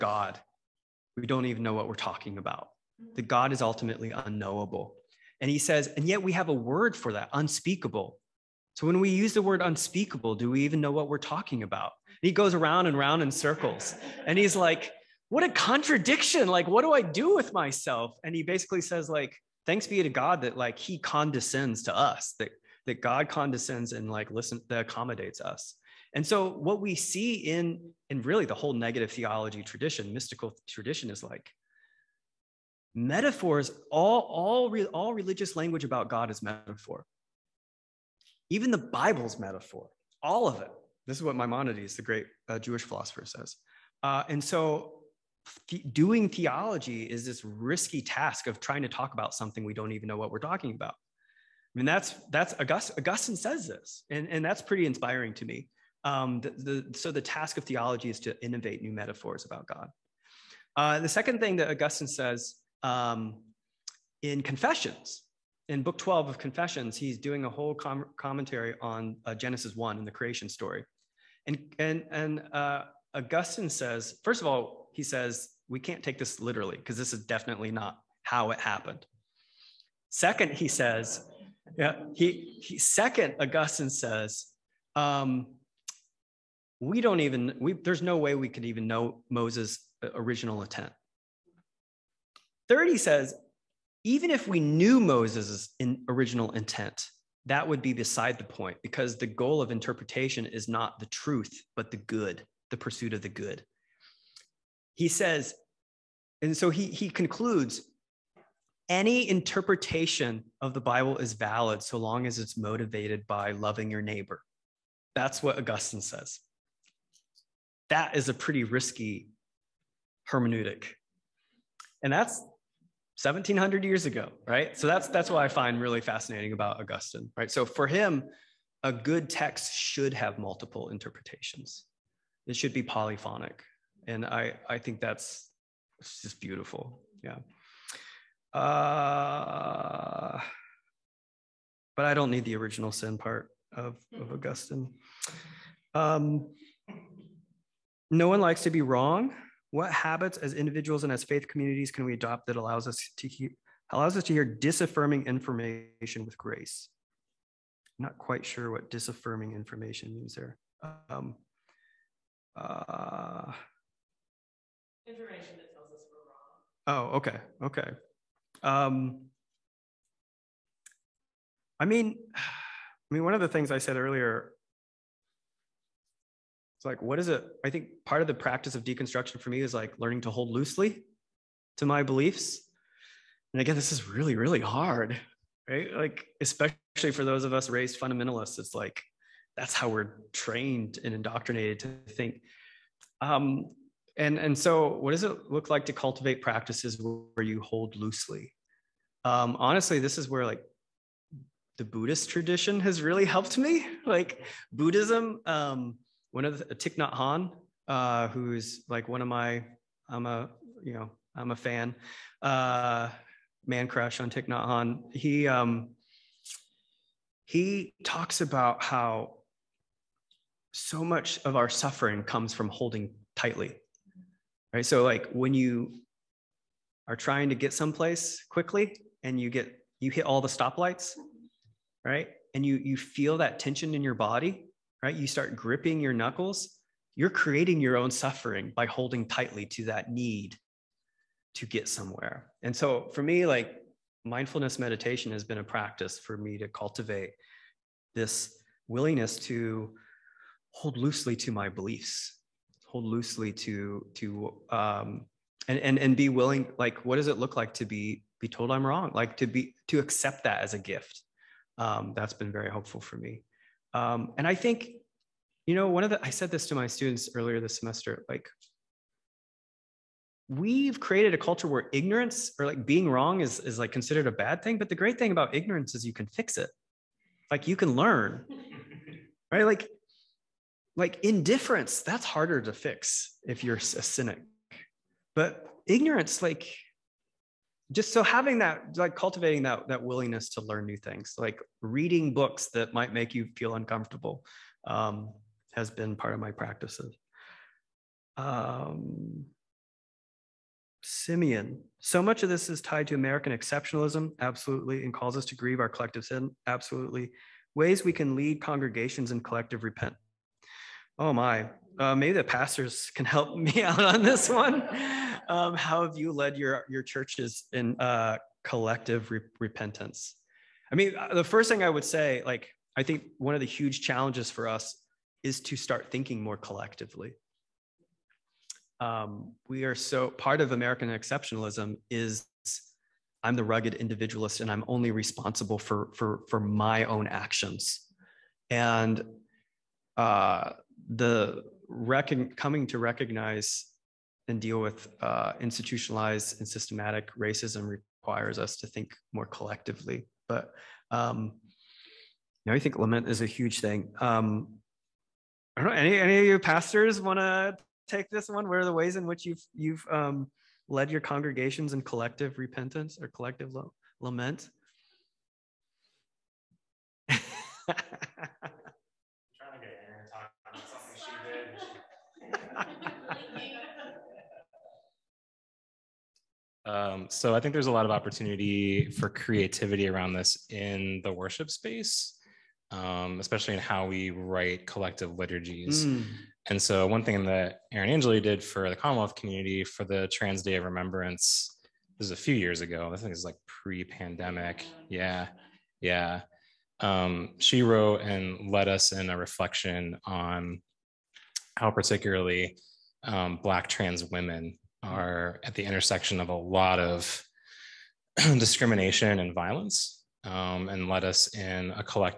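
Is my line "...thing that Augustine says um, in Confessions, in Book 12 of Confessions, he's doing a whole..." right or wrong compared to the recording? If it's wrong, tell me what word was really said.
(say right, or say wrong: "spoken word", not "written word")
right.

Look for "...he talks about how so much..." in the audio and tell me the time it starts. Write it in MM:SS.
03:37.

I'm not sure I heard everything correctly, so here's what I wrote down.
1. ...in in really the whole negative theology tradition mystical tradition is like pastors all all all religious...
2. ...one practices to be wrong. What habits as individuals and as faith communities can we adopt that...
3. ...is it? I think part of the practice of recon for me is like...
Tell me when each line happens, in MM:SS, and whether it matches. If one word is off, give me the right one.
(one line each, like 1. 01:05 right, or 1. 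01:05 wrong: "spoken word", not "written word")
1. 00:27 wrong: "metaphors", not "pastors"
2. 02:28 wrong: "likes", not "practices"
3. 02:57 wrong: "deconstruction", not "recon".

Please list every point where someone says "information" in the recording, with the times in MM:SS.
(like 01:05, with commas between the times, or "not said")
02:35, 02:39, 02:45.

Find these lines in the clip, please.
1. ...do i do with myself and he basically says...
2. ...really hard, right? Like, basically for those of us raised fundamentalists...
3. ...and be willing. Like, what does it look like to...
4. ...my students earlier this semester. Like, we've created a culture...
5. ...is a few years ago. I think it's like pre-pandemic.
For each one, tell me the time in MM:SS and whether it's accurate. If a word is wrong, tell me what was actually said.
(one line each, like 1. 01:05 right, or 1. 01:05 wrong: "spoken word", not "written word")
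1. 00:16 right
2. 03:04 wrong: "especially", not "basically"
3. 04:15 right
4. 04:26 right
5. 06:32 right.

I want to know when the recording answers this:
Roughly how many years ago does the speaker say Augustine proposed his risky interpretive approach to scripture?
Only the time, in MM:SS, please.
02:03.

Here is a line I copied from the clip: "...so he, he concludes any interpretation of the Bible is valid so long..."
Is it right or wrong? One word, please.
right.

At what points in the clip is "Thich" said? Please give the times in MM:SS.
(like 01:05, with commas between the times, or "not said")
03:26, 03:34.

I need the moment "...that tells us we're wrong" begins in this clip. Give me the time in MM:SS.
02:45.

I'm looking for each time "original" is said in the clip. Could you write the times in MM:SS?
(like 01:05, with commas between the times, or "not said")
01:30, 01:36, 02:22.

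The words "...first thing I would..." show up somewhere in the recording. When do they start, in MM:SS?
05:21.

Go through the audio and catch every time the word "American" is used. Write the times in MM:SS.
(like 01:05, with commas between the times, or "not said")
05:03, 05:30.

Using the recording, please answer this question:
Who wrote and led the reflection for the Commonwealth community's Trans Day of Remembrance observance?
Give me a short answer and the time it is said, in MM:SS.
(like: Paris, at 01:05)
Aaron Angeli, at 06:27.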